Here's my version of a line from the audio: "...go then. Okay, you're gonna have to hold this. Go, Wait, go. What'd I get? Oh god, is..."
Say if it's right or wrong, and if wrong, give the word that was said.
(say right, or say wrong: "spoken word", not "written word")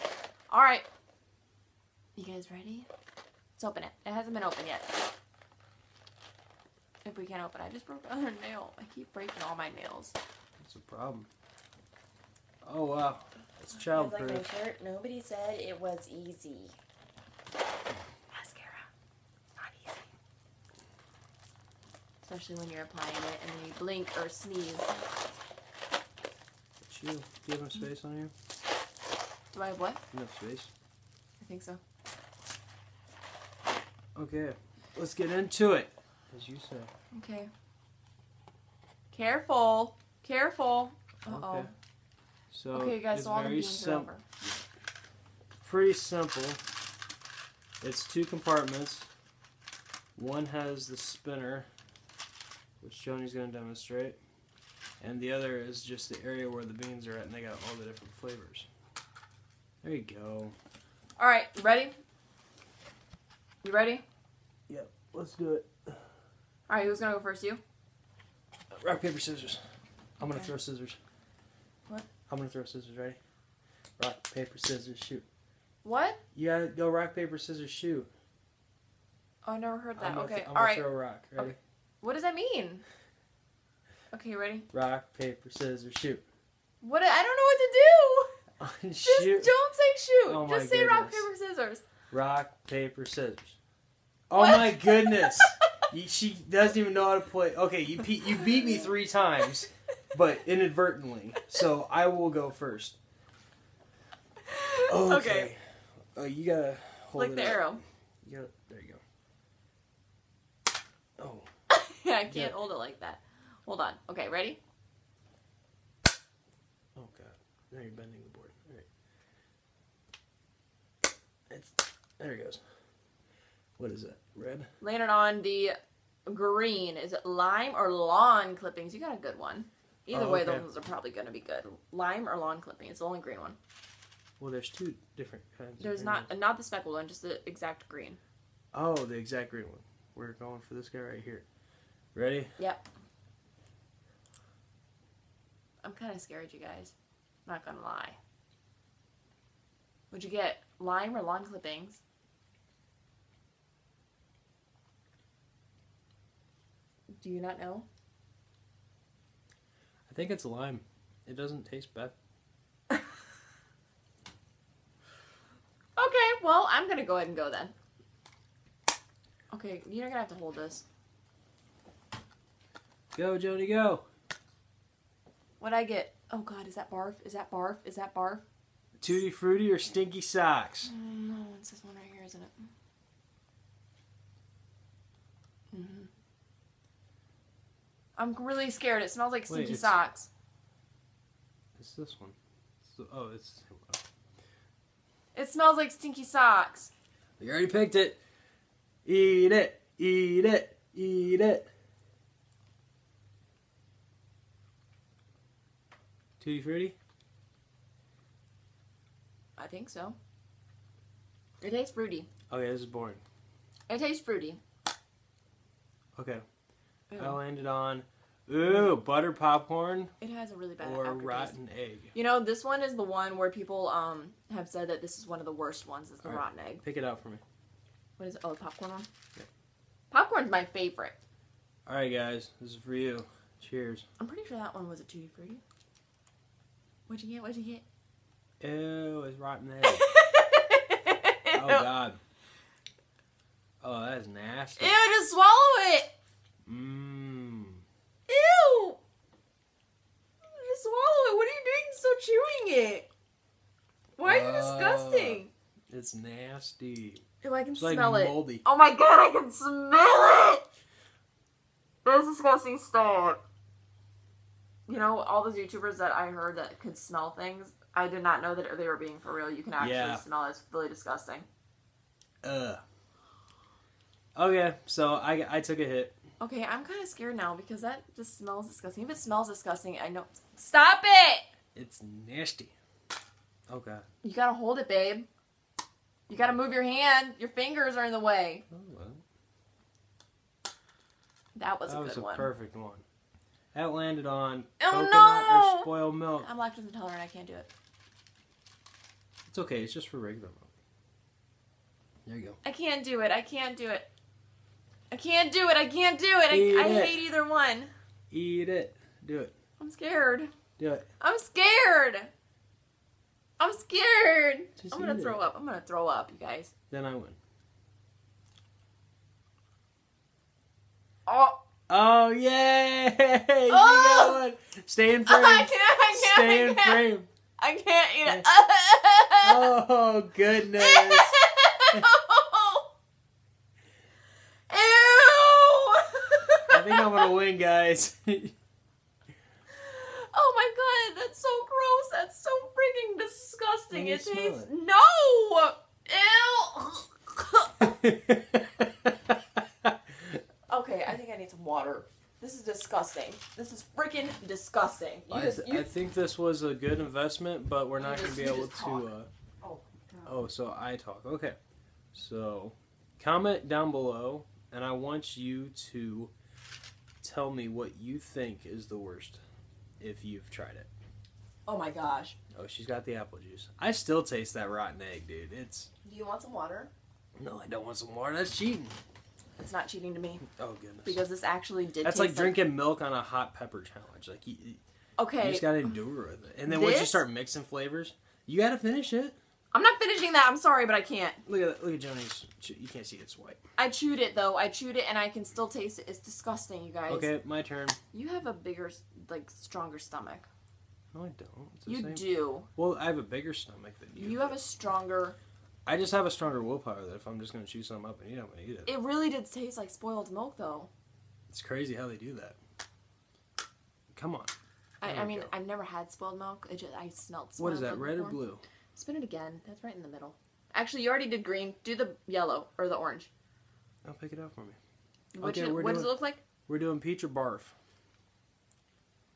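wrong: "Jody", not "Wait".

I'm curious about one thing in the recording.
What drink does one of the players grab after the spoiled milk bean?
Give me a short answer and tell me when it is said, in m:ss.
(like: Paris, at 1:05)
Apple juice, at 6:13.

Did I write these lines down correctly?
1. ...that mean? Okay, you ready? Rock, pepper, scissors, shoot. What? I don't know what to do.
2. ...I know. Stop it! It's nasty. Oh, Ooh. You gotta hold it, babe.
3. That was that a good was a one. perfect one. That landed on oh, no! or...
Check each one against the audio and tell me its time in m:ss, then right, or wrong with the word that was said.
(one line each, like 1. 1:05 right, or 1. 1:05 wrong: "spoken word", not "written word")
1. 1:22 wrong: "paper", not "pepper"
2. 4:39 wrong: "God", not "Ooh"
3. 4:51 right.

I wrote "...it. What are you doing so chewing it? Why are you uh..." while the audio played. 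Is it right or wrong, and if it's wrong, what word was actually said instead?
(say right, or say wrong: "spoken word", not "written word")
right.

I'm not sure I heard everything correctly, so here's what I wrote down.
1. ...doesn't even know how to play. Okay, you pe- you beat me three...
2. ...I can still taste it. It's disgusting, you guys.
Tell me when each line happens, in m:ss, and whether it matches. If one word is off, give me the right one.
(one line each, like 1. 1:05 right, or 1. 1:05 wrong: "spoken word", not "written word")
1. 1:36 right
2. 6:35 right.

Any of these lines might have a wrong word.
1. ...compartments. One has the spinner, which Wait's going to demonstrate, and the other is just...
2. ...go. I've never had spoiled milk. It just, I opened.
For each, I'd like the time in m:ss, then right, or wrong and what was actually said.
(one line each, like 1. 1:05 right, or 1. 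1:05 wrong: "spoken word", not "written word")
1. 0:48 wrong: "Joanie", not "Wait"
2. 6:55 wrong: "smelled", not "opened".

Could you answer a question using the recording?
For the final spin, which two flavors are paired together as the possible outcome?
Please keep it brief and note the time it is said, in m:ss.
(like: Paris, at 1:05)
Peach or barf, at 7:06.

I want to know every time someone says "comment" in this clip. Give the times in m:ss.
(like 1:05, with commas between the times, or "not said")
6:03.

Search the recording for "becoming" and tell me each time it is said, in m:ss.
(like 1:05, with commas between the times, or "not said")
not said.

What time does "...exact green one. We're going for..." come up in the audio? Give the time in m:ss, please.
2:19.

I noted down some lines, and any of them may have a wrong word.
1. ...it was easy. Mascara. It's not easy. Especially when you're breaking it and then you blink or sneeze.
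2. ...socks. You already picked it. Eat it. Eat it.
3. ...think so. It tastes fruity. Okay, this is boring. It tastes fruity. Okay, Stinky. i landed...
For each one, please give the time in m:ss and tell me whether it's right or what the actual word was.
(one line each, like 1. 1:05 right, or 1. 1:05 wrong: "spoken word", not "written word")
1. 0:15 wrong: "applying", not "breaking"
2. 3:16 right
3. 3:29 wrong: "Ooh", not "Stinky".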